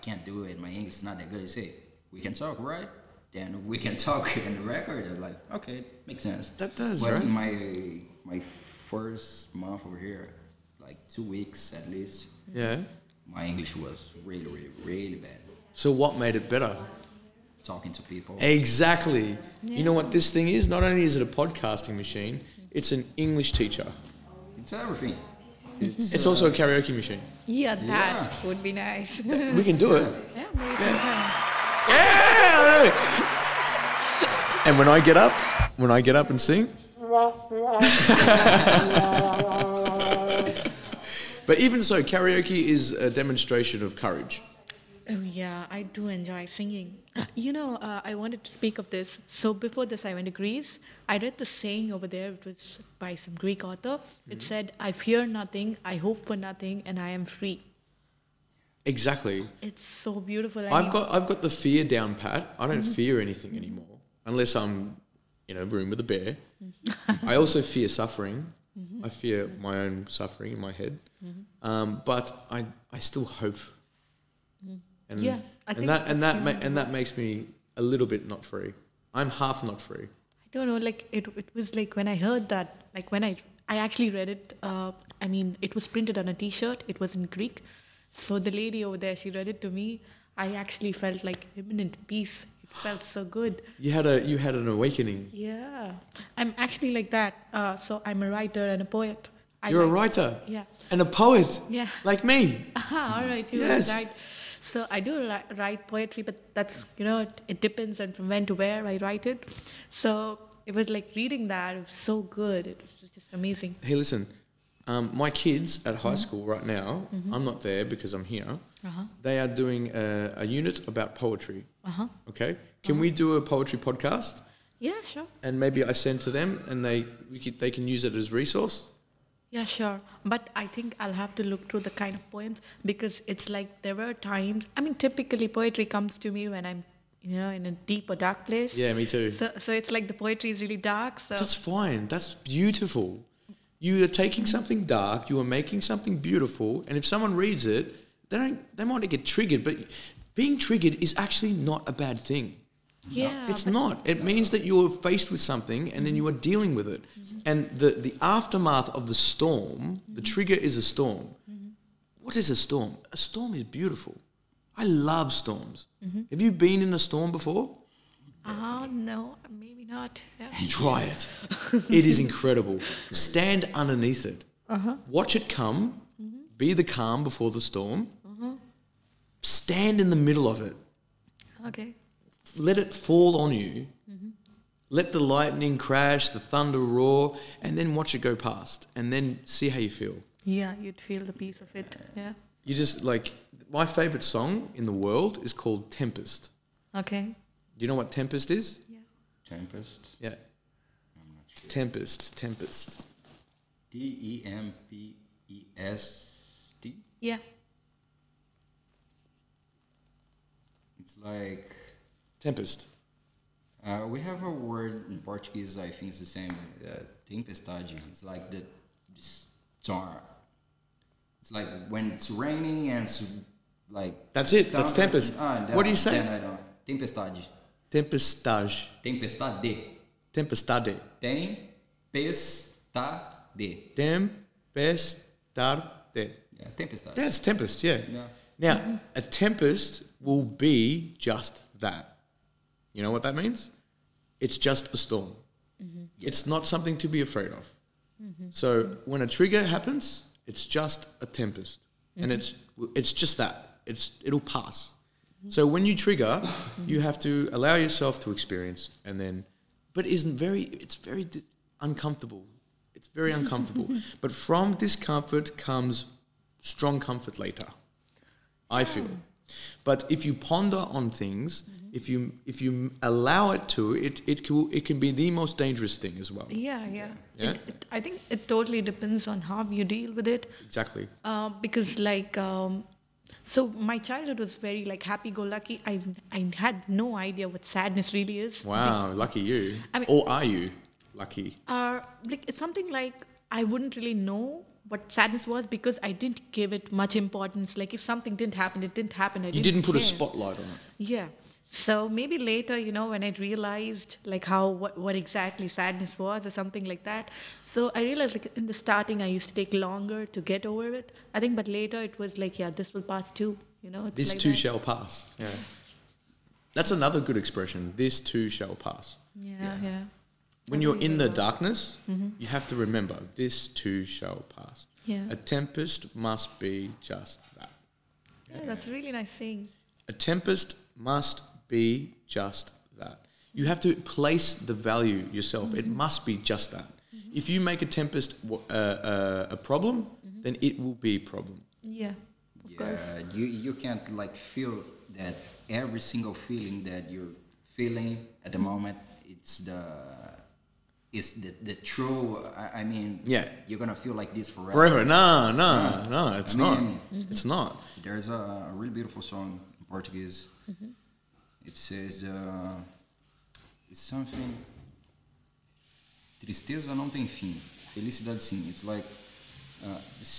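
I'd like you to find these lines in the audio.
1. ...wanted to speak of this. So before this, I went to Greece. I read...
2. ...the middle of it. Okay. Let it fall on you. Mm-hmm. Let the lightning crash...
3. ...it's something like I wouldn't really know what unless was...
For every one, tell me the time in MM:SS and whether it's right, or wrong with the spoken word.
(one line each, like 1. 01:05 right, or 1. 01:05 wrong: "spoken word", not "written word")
1. 00:48 right
2. 03:00 right
3. 04:52 wrong: "sadness", not "unless".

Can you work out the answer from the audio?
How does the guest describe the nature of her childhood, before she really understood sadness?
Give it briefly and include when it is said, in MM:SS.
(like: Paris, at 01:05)
happy-go-lucky, at 04:45.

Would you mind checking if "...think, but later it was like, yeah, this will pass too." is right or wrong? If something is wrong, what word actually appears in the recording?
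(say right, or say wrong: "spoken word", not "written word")
right.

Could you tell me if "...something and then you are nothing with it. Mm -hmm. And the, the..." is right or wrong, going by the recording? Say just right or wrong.
wrong.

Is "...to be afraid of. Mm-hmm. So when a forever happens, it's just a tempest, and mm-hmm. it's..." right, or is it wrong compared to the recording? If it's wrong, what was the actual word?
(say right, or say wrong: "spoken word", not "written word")
wrong: "trigger", not "forever".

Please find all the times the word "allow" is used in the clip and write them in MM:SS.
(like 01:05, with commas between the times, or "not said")
04:17, 04:33.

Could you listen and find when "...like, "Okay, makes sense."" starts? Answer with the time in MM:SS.
00:05.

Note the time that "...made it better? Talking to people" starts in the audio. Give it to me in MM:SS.
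00:16.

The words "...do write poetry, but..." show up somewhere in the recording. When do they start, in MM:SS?
01:45.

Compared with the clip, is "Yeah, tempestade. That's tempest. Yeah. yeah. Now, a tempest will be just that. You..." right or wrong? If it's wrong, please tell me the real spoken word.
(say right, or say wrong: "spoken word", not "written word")
right.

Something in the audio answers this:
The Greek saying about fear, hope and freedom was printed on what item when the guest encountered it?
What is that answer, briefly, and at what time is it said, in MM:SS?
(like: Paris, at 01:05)
T-shirt, at 01:26.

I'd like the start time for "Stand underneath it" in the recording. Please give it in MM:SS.
02:53.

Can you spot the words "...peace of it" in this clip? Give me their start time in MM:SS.
03:11.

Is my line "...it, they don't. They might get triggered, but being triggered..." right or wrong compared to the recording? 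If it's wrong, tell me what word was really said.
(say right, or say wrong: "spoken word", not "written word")
right.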